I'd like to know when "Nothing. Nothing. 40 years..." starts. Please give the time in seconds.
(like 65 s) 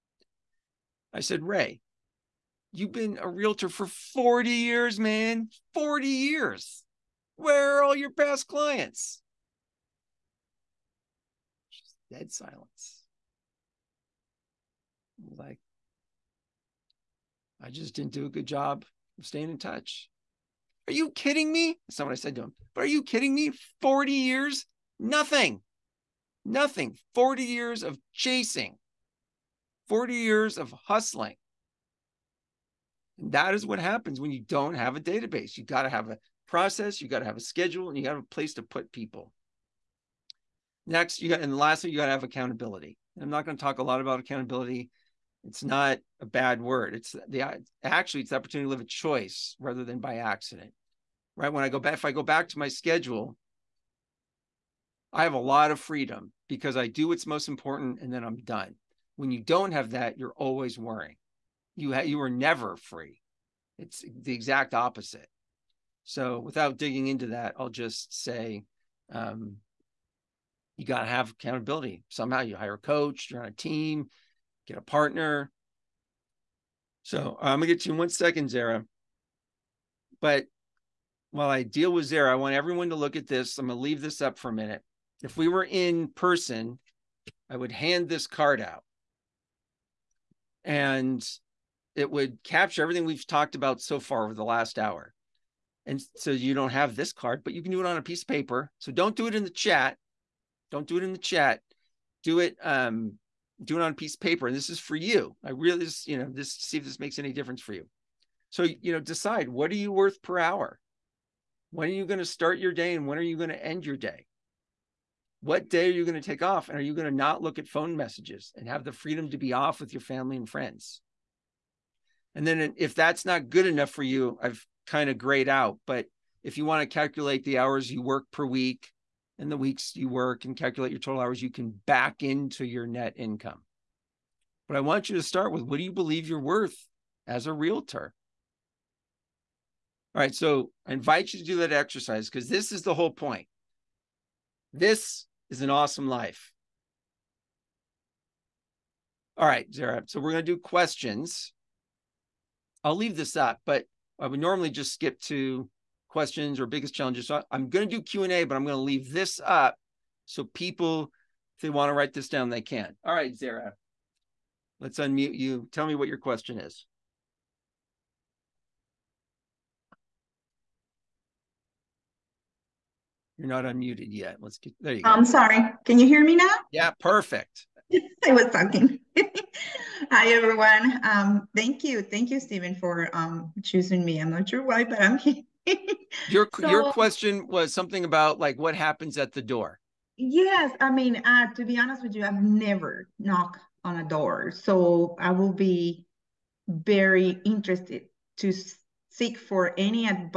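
24 s.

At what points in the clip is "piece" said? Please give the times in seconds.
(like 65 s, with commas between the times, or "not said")
98 s, 103 s.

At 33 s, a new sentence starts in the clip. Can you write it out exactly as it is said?
And that is what happens when you don't have a database.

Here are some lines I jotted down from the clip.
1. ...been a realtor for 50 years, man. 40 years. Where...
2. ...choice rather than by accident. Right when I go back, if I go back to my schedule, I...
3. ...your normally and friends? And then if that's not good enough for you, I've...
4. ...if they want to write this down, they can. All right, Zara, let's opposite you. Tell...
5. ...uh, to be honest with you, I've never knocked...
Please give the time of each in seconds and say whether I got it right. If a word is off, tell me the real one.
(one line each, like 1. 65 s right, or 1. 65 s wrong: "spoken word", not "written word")
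1. 2 s wrong: "40", not "50"
2. 48 s right
3. 119 s wrong: "family", not "normally"
4. 161 s wrong: "unmute", not "opposite"
5. 191 s right.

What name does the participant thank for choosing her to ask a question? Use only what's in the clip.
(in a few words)
Steven.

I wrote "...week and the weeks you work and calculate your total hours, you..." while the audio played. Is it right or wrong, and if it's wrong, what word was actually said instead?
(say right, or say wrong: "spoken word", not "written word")
right.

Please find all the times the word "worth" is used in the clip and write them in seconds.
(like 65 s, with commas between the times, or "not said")
109 s, 136 s.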